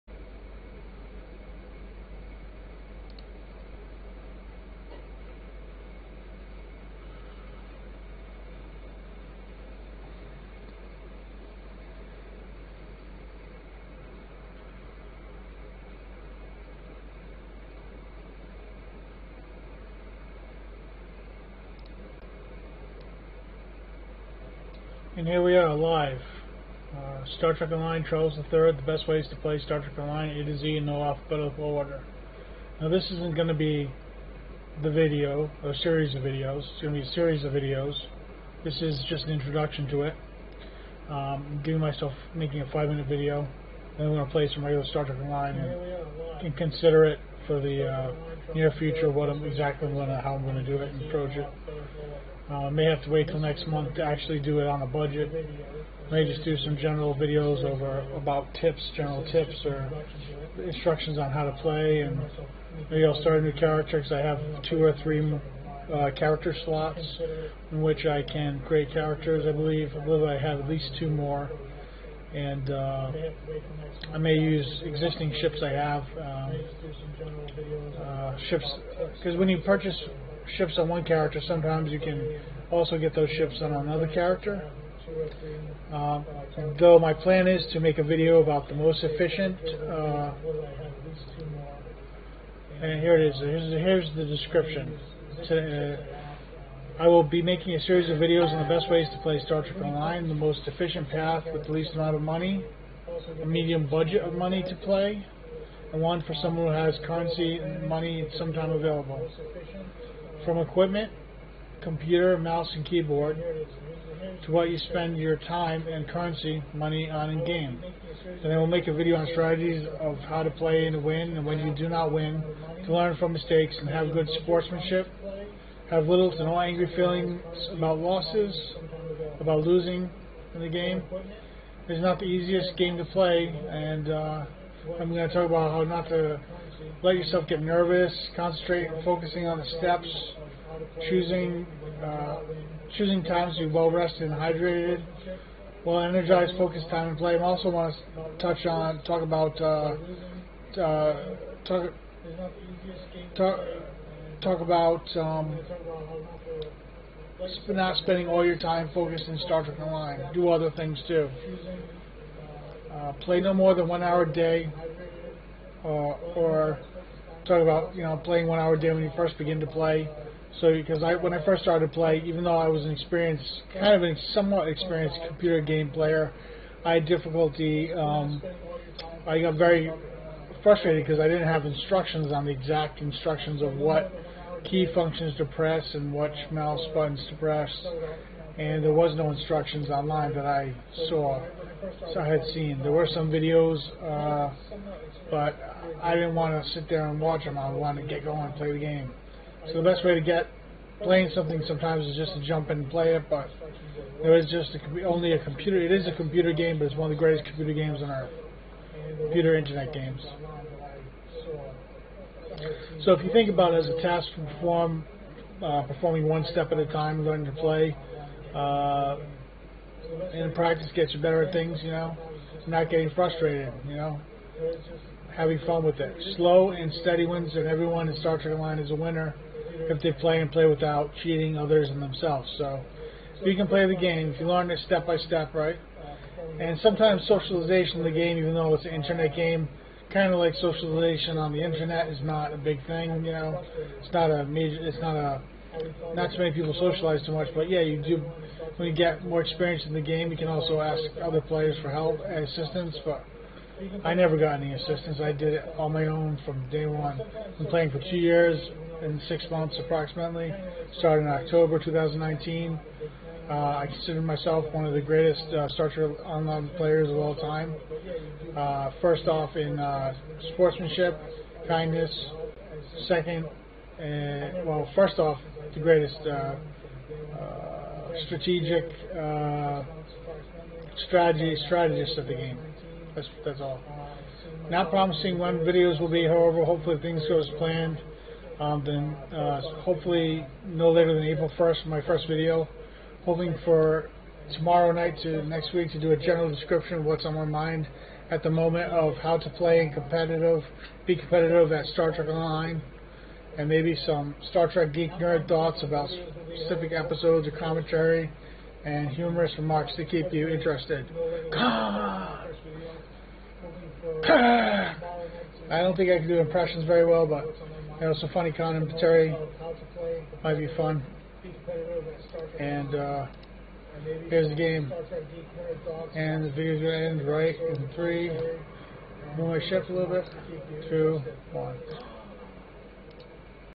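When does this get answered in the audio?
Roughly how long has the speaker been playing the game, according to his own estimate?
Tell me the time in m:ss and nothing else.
4:17.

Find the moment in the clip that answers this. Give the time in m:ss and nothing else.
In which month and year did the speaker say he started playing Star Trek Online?
4:21.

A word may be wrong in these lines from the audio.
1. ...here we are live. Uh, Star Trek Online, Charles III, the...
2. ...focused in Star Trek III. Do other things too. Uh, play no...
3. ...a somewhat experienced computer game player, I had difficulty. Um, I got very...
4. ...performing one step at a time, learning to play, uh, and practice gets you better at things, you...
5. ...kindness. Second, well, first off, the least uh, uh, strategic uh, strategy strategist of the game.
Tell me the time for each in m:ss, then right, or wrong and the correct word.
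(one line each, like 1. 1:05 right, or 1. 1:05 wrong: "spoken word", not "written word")
1. 0:25 right
2. 2:38 wrong: "Online", not "III"
3. 2:54 right
4. 3:35 right
5. 4:31 wrong: "greatest", not "least".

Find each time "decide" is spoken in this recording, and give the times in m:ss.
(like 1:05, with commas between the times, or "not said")
not said.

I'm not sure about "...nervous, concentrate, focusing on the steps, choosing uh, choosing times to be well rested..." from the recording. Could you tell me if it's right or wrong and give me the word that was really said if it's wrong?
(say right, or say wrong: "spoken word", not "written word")
right.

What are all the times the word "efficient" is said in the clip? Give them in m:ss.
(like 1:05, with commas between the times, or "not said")
1:29, 1:40.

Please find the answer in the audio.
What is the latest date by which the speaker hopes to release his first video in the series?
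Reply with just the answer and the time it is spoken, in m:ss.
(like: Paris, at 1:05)
April 1st, at 4:51.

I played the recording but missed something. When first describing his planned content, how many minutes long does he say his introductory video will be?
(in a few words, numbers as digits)
5.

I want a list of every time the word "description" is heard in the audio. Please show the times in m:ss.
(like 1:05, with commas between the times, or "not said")
1:34, 4:56.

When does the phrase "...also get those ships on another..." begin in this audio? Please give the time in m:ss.
1:22.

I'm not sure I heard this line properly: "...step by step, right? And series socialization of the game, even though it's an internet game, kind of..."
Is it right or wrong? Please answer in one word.
wrong.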